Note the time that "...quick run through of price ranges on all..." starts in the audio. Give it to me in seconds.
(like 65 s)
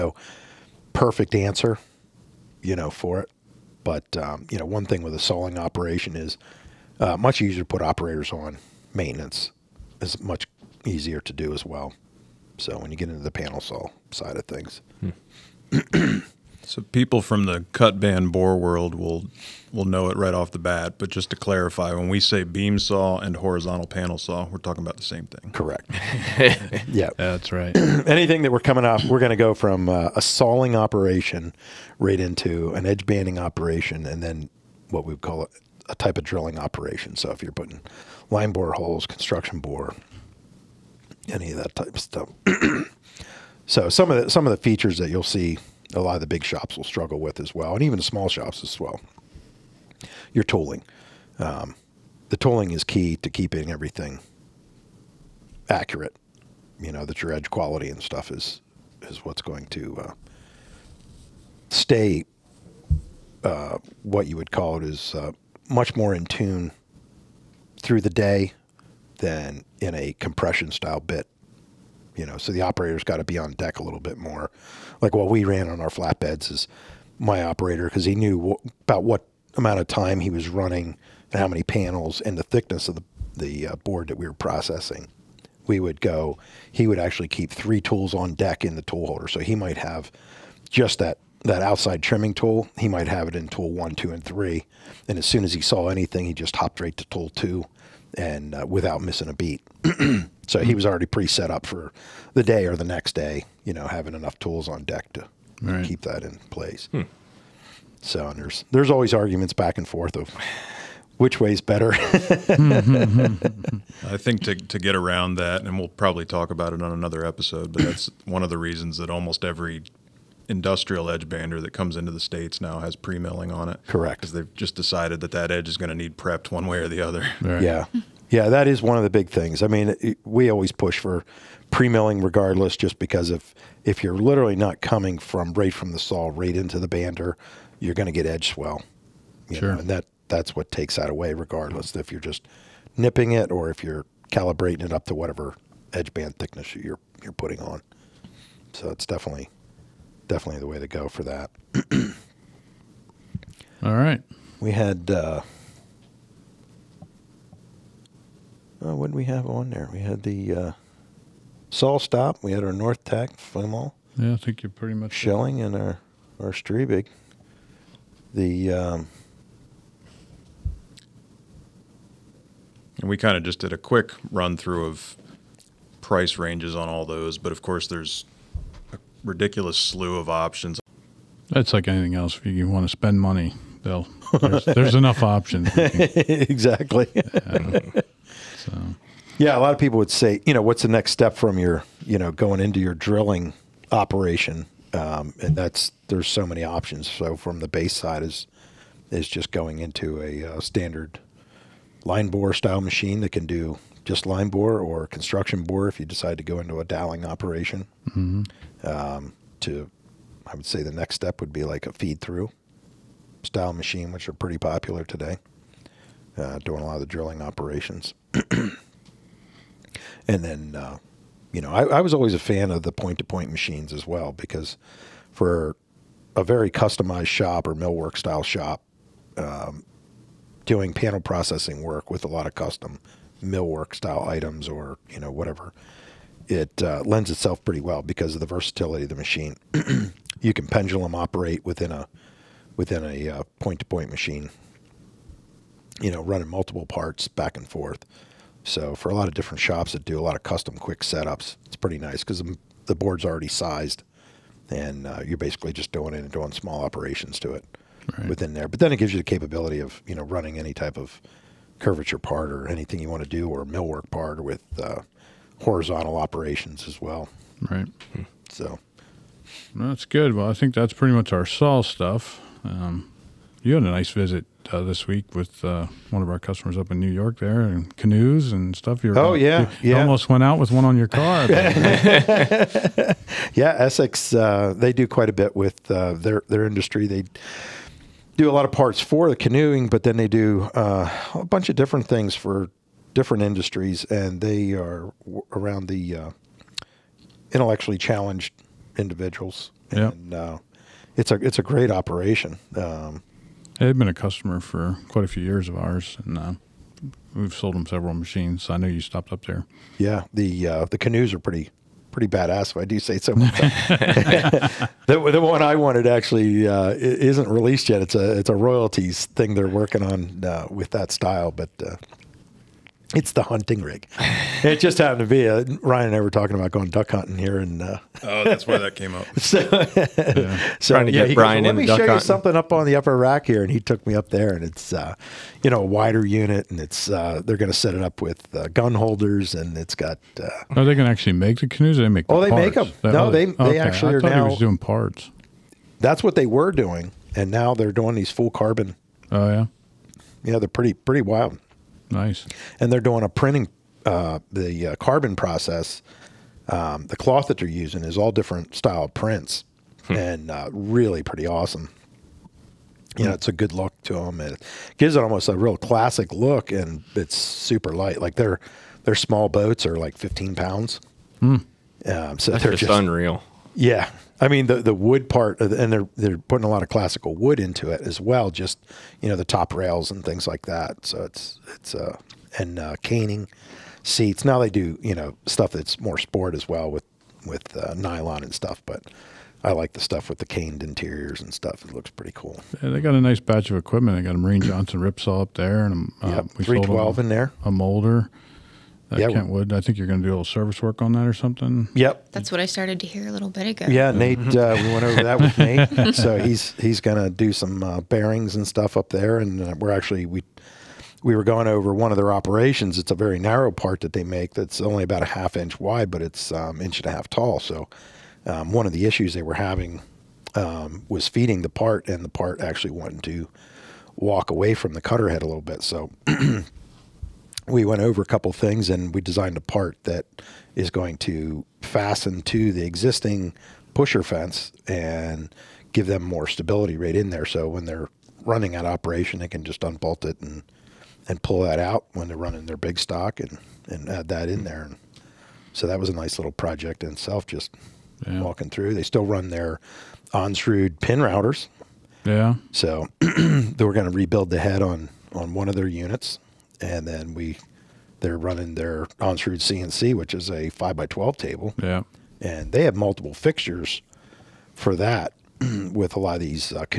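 173 s.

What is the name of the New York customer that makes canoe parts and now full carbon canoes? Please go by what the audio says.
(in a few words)
Essex.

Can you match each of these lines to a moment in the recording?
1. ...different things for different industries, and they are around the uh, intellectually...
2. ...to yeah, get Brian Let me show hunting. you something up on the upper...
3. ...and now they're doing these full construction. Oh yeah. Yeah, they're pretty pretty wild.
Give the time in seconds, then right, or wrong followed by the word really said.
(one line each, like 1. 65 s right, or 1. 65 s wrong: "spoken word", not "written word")
1. 291 s right
2. 331 s right
3. 347 s wrong: "carbon", not "construction".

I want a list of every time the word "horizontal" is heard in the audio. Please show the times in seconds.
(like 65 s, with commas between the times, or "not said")
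23 s, 265 s.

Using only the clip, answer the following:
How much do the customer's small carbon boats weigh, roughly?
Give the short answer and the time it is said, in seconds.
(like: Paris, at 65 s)
15 pounds, at 370 s.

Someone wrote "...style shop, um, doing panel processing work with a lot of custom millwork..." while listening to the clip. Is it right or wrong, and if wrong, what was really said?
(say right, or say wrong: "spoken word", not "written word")
right.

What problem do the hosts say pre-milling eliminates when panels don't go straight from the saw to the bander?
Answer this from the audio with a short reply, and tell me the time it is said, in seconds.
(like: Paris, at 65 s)
Edge swell, at 138 s.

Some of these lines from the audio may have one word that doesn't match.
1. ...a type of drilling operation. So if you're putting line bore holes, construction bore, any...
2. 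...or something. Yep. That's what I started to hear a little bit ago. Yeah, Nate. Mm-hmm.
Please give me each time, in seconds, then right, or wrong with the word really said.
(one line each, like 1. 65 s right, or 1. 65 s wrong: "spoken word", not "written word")
1. 35 s right
2. 401 s right.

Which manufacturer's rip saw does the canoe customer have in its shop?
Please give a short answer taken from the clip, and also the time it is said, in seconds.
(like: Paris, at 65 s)
Mereen Johnson, at 394 s.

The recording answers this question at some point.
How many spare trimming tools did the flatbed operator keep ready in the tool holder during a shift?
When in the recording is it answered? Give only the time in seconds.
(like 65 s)
87 s.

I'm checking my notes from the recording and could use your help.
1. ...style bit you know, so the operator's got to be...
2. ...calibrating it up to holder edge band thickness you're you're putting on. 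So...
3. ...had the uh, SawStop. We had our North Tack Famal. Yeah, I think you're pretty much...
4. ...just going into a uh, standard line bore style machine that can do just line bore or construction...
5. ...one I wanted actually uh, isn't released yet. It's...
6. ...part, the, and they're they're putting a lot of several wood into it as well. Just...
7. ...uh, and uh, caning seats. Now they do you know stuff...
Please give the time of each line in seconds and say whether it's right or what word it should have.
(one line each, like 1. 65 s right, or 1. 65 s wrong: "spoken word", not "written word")
1. 70 s right
2. 144 s wrong: "whatever", not "holder"
3. 160 s right
4. 199 s right
5. 315 s right
6. 375 s wrong: "classical", not "several"
7. 381 s right.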